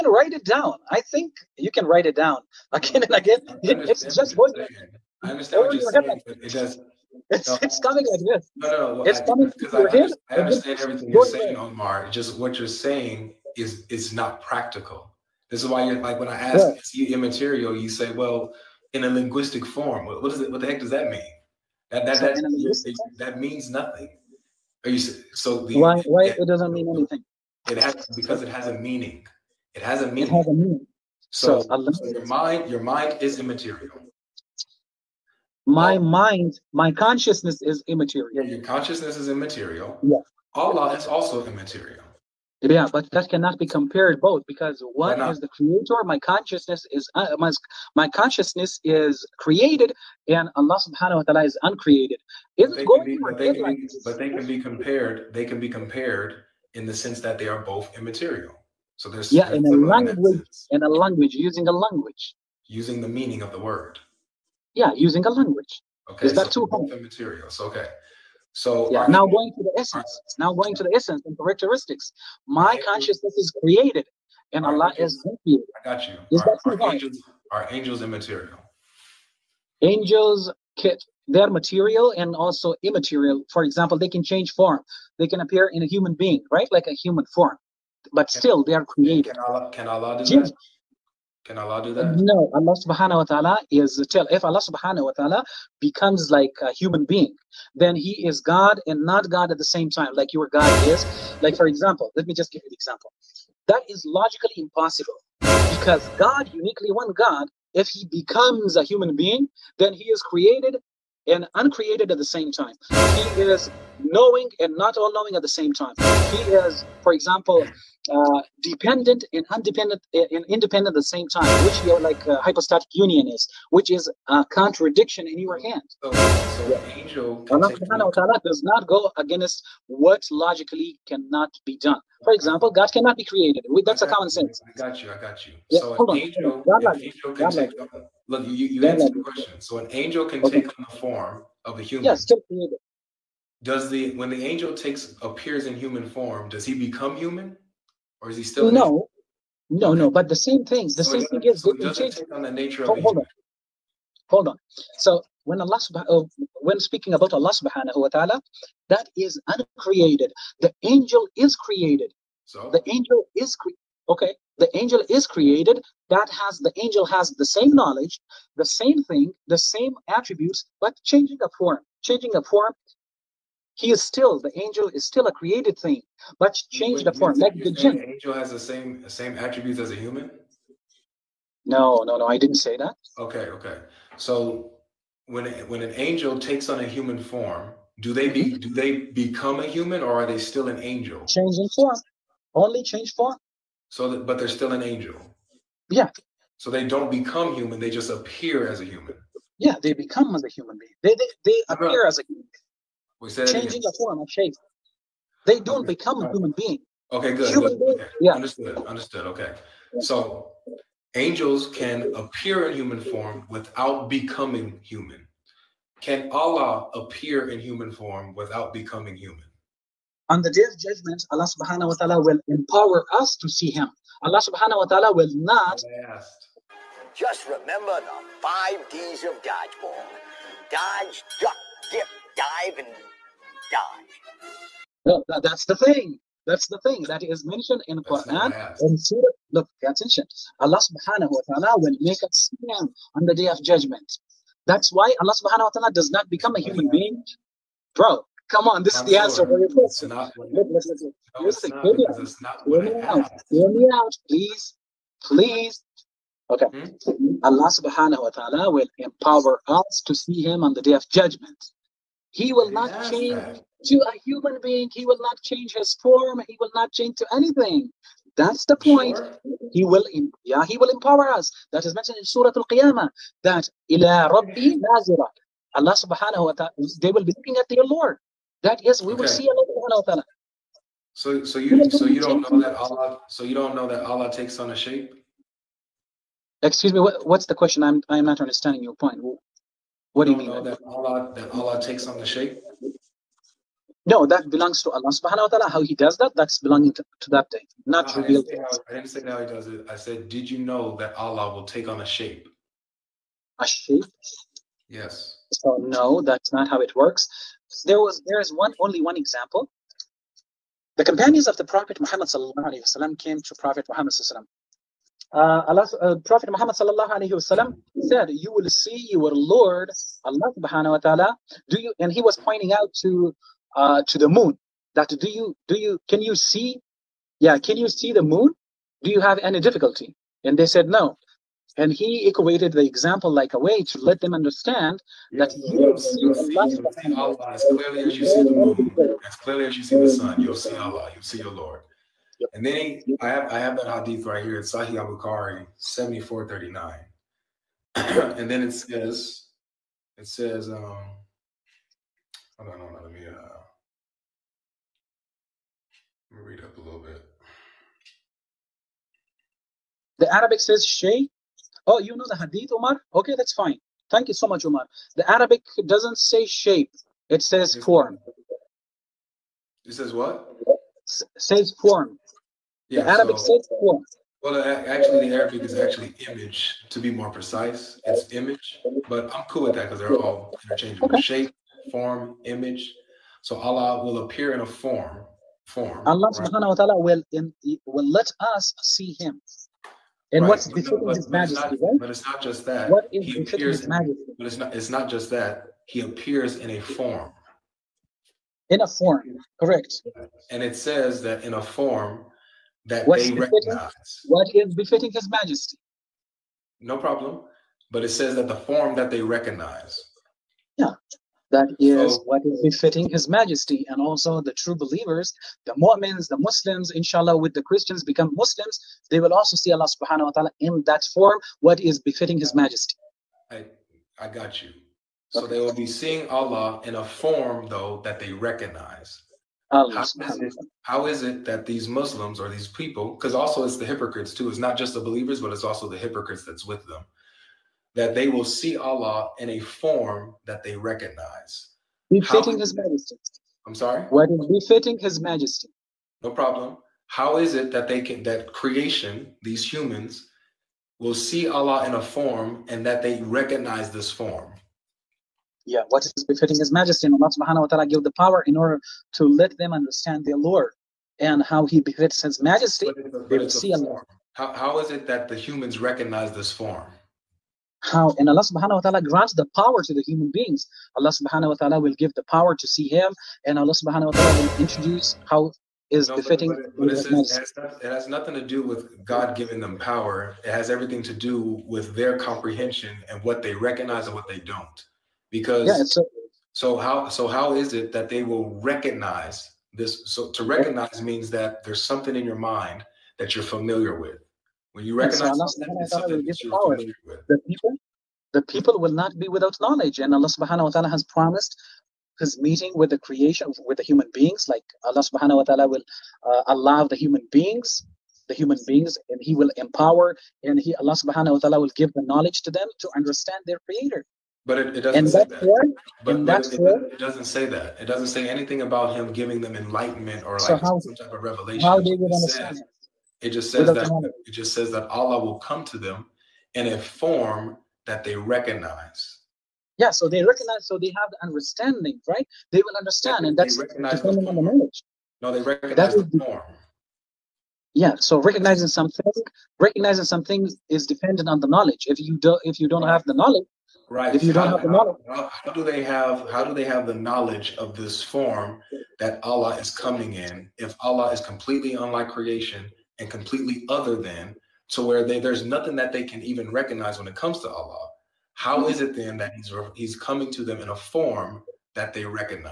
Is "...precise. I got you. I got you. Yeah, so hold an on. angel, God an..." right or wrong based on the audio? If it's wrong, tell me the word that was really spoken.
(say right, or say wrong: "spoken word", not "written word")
wrong: "sense", not "precise".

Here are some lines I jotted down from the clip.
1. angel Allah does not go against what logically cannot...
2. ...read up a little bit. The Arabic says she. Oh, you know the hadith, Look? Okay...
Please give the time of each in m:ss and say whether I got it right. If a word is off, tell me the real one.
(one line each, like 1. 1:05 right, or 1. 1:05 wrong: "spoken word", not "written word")
1. 2:06 right
2. 5:56 wrong: "Umar", not "Look".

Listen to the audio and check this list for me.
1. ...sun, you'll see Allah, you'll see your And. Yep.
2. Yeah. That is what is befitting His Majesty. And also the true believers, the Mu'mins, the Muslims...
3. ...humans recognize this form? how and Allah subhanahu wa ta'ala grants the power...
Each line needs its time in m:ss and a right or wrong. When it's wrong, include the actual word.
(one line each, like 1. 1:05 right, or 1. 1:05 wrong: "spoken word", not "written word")
1. 5:40 wrong: "Lord", not "And"
2. 6:50 right
3. 7:45 right.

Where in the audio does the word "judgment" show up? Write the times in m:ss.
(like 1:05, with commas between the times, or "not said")
3:40, 4:03, 4:21.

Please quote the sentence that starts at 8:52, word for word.
They will understand, yeah, and that's recognizing on the knowledge.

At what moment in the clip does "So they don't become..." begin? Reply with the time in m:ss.
3:16.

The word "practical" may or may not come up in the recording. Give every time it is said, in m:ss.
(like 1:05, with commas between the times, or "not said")
0:14.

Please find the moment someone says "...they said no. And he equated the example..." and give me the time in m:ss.
5:30.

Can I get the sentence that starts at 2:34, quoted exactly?
So when Allah subhanahu uh, when speaking about Allah subhanahu wa taala, that is uncreated.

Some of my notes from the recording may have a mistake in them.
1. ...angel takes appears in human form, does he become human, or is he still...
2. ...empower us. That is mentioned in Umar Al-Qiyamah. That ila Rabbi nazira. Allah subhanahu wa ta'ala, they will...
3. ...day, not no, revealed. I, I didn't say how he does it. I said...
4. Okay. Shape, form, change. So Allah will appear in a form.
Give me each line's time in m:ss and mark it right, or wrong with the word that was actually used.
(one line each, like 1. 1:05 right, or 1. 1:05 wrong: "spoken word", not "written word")
1. 2:24 right
2. 4:30 wrong: "Surah", not "Umar"
3. 4:57 right
4. 6:21 wrong: "image", not "change".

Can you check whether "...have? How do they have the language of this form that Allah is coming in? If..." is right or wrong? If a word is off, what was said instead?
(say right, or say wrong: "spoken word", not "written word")
wrong: "knowledge", not "language".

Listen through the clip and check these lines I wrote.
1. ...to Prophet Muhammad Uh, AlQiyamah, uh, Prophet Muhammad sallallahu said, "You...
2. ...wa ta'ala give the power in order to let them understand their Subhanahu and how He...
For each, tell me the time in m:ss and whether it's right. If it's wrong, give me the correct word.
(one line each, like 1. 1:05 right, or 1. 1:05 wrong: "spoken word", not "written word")
1. 5:13 wrong: "Allah", not "AlQiyamah"
2. 7:37 wrong: "Lord", not "Subhanahu".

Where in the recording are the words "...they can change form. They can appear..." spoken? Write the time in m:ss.
1:23.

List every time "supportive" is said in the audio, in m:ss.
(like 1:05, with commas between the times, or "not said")
not said.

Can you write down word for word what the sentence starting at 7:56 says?
But, but, but it, says, it, has not, it, has nothing to do with God giving them power.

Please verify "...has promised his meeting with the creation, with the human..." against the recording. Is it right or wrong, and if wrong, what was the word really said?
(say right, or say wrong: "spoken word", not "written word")
right.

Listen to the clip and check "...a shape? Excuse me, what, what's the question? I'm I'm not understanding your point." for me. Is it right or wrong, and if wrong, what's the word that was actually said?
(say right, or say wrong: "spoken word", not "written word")
right.